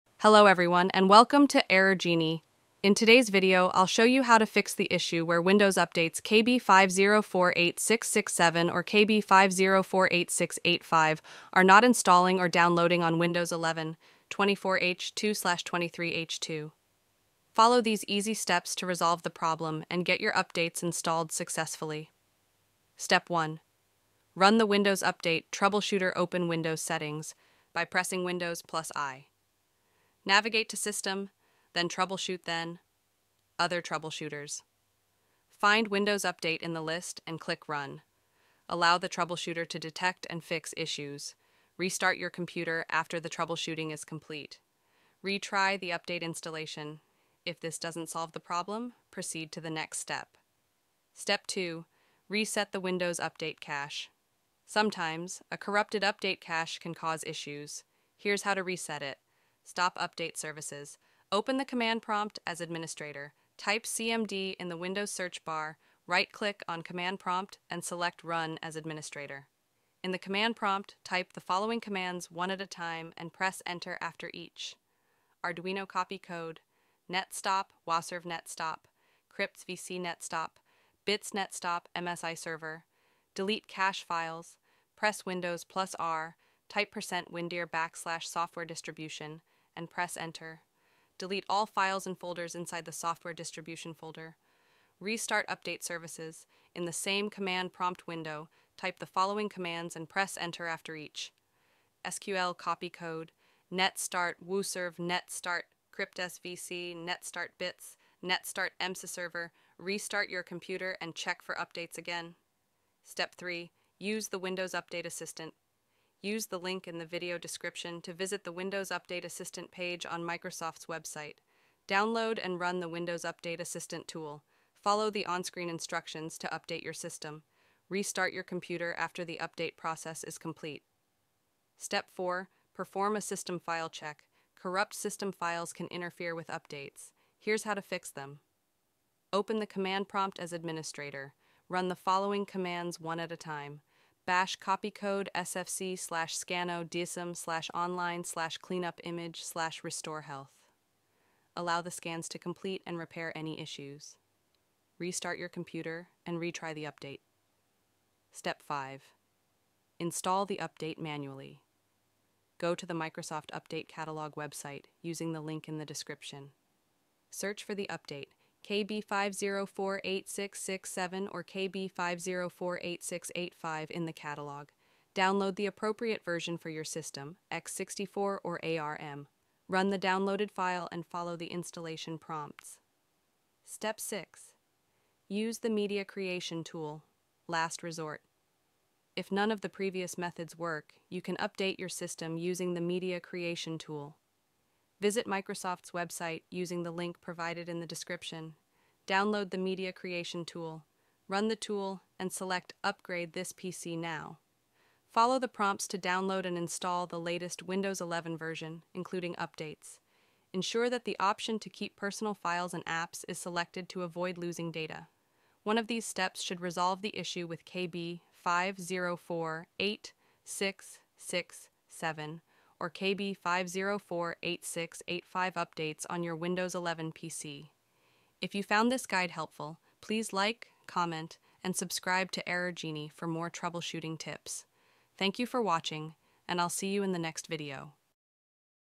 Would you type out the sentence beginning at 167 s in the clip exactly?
Search for the update KB5048667 or KB5048685 in the catalog.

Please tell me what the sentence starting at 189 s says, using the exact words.
If none of the previous methods work, you can update your system using the Media Creation tool.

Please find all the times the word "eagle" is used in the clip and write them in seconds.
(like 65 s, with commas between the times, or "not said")
not said.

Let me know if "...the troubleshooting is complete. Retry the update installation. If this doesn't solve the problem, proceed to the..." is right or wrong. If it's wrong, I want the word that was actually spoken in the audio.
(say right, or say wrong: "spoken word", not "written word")
right.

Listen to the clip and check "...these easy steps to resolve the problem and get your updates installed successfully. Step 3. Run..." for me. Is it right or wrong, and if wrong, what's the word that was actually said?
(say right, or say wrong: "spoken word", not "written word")
wrong: "1", not "3".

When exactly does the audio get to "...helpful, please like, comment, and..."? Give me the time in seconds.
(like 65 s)
229 s.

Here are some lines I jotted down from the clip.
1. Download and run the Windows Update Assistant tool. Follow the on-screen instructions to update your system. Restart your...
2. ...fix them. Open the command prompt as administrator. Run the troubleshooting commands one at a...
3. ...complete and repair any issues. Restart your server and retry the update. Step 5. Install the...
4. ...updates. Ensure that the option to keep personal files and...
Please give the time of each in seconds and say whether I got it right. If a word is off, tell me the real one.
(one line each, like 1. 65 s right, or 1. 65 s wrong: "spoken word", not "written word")
1. 121 s right
2. 137 s wrong: "following", not "troubleshooting"
3. 152 s wrong: "computer", not "server"
4. 209 s right.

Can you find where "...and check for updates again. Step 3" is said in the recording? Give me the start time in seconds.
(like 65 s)
111 s.